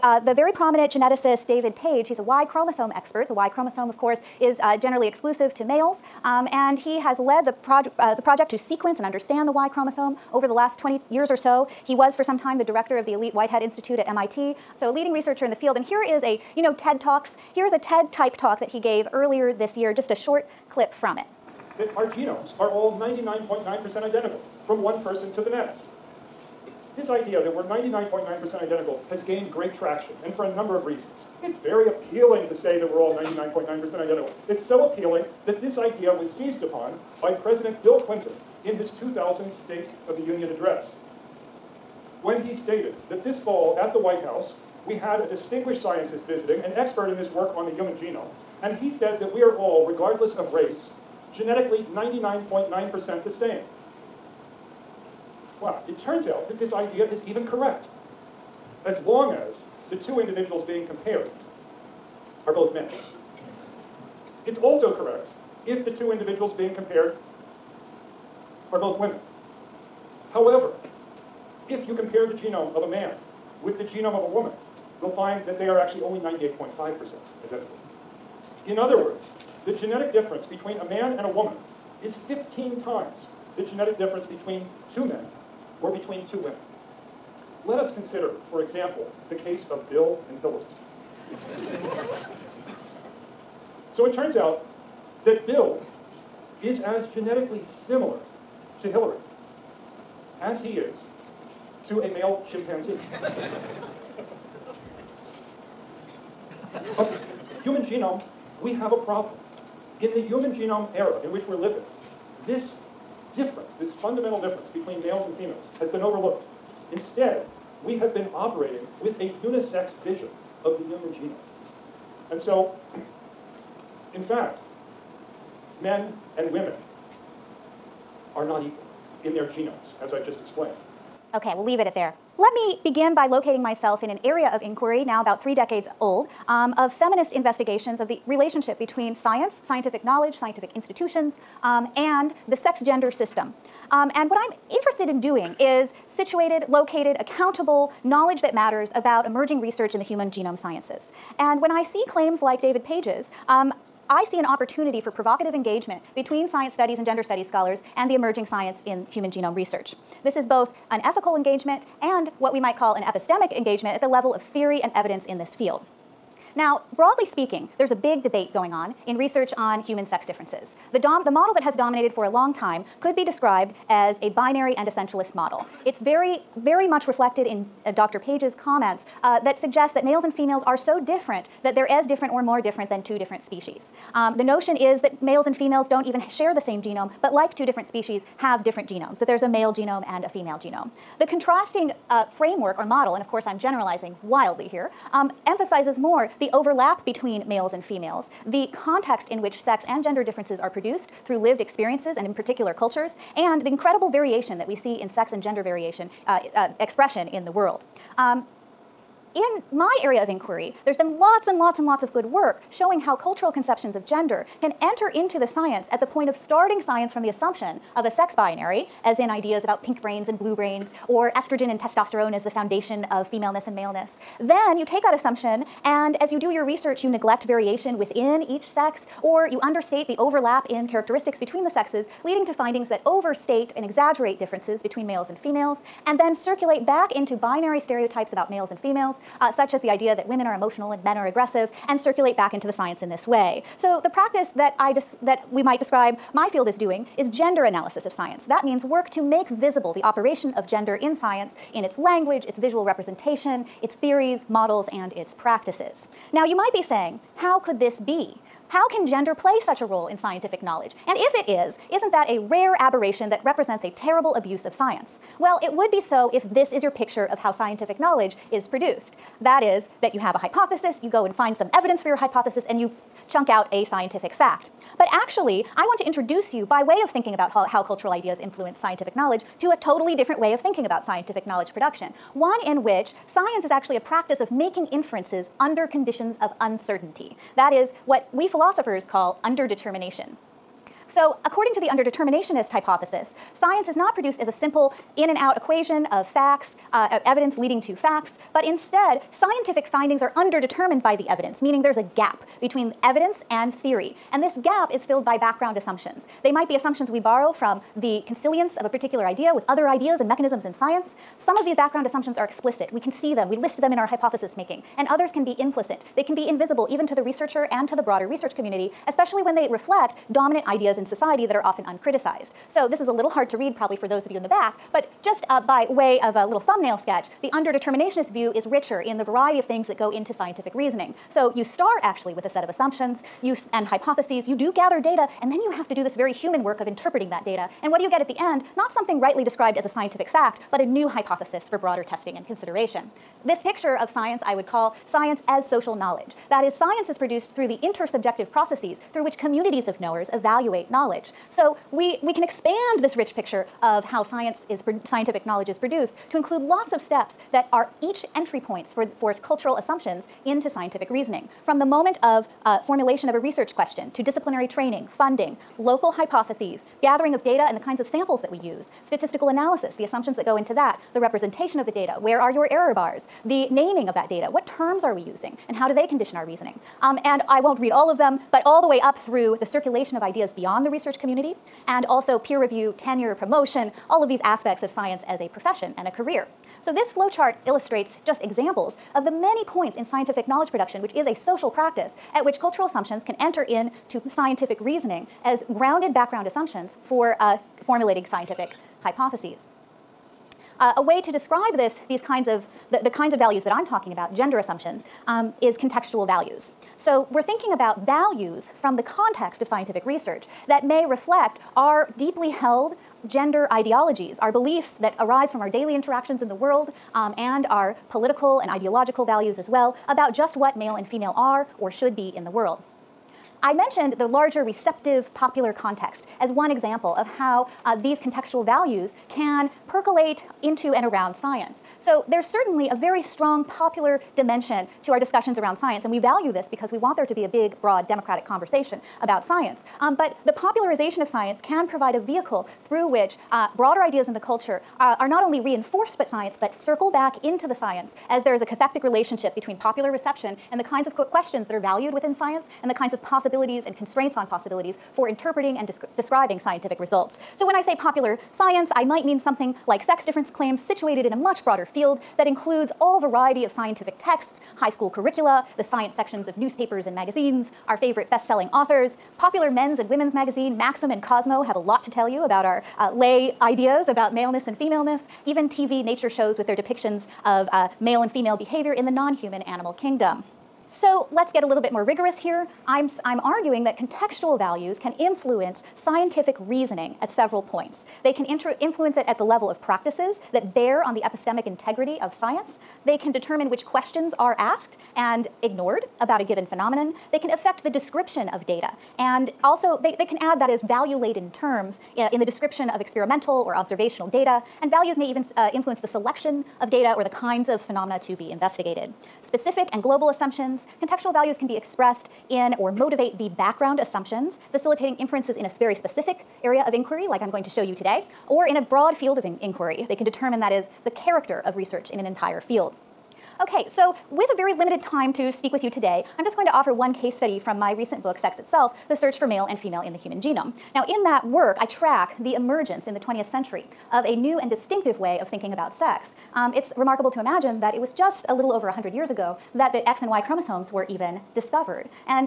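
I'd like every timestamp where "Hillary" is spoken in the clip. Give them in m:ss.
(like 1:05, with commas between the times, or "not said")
1:30, 1:38.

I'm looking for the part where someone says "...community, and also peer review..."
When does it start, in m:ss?
6:21.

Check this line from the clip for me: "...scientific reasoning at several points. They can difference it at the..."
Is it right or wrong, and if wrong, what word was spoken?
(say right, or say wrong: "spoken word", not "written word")
wrong: "influence", not "difference".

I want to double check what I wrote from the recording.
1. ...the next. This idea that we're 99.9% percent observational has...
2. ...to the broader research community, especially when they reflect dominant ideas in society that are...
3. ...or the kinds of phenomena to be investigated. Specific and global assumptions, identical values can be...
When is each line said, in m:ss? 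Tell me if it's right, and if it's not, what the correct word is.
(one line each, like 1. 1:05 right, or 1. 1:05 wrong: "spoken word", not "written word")
1. 0:25 wrong: "identical", not "observational"
2. 5:17 right
3. 8:27 wrong: "contextual", not "identical".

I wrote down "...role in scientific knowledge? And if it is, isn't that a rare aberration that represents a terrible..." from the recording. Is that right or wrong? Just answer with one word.
right.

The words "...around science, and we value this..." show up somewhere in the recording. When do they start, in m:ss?
7:15.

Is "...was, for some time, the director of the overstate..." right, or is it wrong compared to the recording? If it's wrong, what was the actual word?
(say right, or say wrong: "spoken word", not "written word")
wrong: "elite", not "overstate".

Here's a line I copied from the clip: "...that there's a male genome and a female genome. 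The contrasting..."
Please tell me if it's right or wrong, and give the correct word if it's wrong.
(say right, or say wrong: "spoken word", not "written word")
right.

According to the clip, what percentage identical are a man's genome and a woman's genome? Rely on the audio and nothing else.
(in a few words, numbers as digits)
98.5%.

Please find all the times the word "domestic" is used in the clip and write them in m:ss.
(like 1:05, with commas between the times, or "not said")
not said.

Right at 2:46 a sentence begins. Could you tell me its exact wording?
Now, broadly speaking, there's a big debate going on in research on human sex differences.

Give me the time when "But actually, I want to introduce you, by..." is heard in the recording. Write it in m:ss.
4:34.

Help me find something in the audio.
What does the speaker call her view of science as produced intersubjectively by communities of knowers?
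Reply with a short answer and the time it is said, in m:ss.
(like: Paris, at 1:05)
science as social knowledge, at 5:45.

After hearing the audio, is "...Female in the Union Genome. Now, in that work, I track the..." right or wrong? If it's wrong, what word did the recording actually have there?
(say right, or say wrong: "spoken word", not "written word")
wrong: "Human", not "Union".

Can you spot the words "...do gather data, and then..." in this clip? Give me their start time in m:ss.
5:34.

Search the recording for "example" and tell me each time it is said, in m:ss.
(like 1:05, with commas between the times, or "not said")
1:28, 6:28, 7:06.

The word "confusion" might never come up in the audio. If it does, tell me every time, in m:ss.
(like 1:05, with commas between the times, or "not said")
not said.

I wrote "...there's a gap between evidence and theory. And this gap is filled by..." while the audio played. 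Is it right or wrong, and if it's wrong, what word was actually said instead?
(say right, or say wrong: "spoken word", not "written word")
right.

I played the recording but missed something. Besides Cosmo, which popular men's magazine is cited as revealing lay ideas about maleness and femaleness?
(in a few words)
Maxim.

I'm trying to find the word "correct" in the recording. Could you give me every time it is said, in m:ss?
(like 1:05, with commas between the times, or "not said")
0:57, 1:04.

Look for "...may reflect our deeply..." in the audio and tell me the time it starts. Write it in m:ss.
6:50.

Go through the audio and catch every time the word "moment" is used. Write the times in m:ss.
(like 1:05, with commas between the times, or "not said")
6:01.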